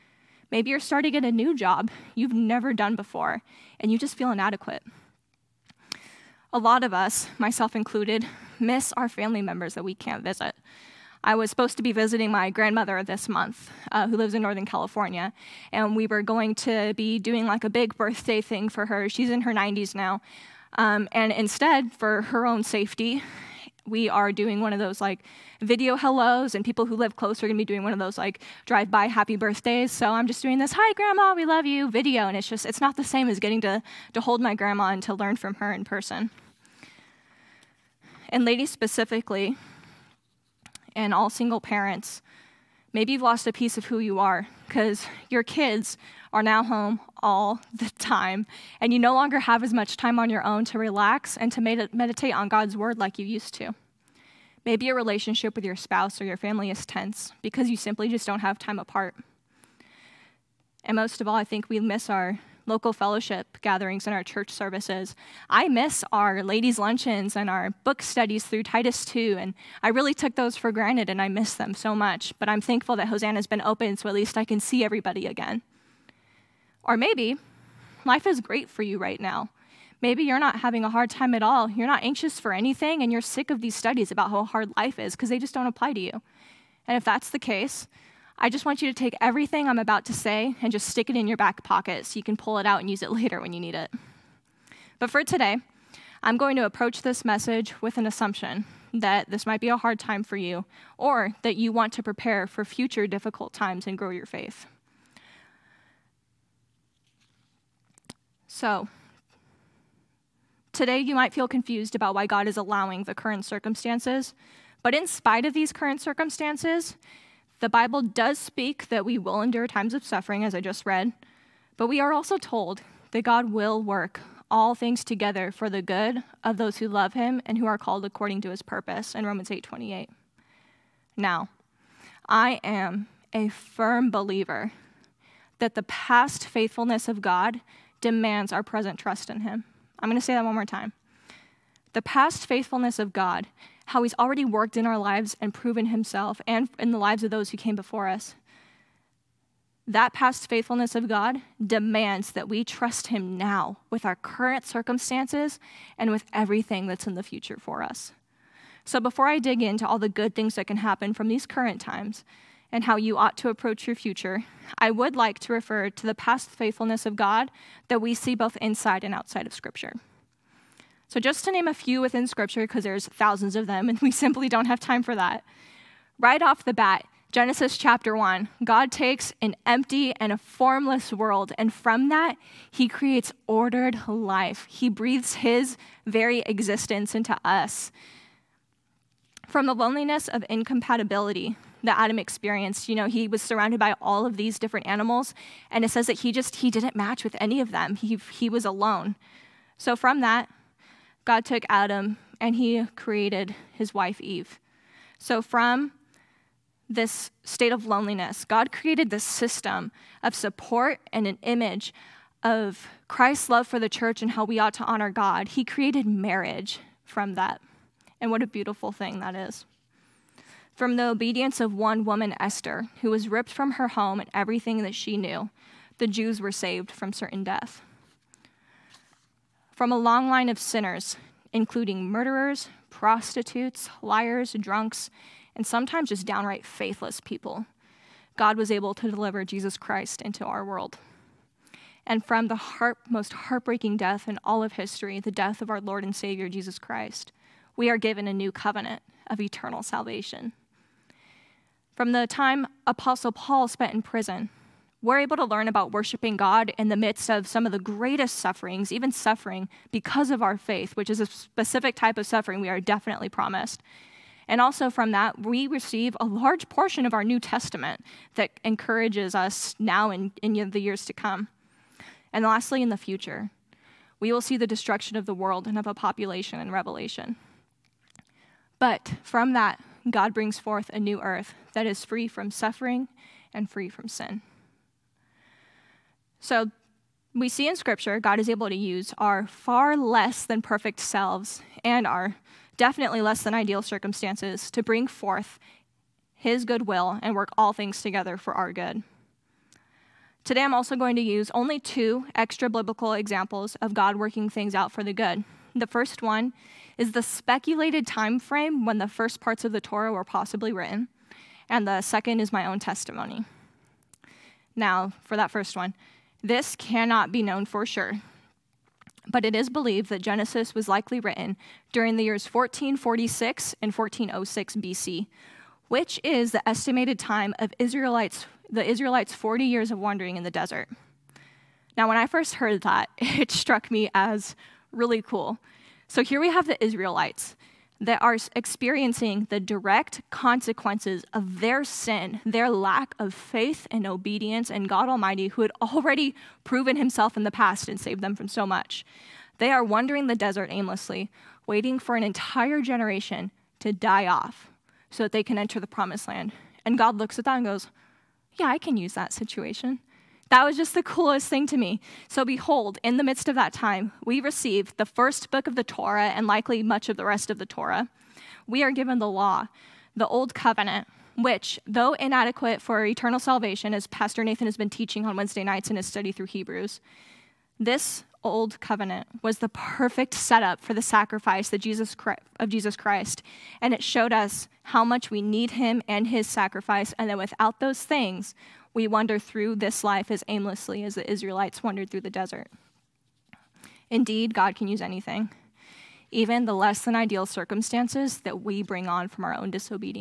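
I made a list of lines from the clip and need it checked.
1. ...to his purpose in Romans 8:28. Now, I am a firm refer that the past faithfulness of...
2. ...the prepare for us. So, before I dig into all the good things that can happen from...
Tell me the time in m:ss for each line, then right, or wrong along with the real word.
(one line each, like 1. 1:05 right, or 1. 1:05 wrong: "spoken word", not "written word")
1. 2:08 wrong: "believer", not "refer"
2. 2:37 wrong: "future", not "prepare".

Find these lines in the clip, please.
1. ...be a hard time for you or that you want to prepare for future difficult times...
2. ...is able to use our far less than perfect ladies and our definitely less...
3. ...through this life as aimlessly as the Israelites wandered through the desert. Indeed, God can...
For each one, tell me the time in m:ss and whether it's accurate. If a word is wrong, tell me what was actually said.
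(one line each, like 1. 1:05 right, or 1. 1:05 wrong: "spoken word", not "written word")
1. 1:39 right
2. 4:48 wrong: "selves", not "ladies"
3. 6:29 right.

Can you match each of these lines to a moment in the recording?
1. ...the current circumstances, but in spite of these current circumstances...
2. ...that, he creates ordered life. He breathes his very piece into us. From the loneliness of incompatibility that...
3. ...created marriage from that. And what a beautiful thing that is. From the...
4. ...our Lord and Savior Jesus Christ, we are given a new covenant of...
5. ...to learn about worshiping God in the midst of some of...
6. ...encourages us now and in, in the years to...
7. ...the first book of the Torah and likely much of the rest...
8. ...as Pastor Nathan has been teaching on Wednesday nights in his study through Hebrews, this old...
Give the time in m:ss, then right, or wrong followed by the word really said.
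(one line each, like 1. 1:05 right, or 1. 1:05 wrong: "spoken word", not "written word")
1. 1:53 right
2. 3:02 wrong: "existence", not "piece"
3. 3:35 right
4. 4:05 right
5. 4:15 right
6. 4:28 right
7. 6:04 right
8. 6:13 right.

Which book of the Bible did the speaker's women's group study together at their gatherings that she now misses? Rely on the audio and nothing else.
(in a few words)
Titus 2.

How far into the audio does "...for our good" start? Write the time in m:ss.
4:58.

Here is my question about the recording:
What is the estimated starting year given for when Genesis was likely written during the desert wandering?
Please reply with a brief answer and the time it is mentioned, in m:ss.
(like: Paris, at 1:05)
1446 BC, at 5:22.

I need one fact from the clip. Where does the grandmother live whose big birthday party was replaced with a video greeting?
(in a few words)
Northern California.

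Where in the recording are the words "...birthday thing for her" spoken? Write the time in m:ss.
0:17.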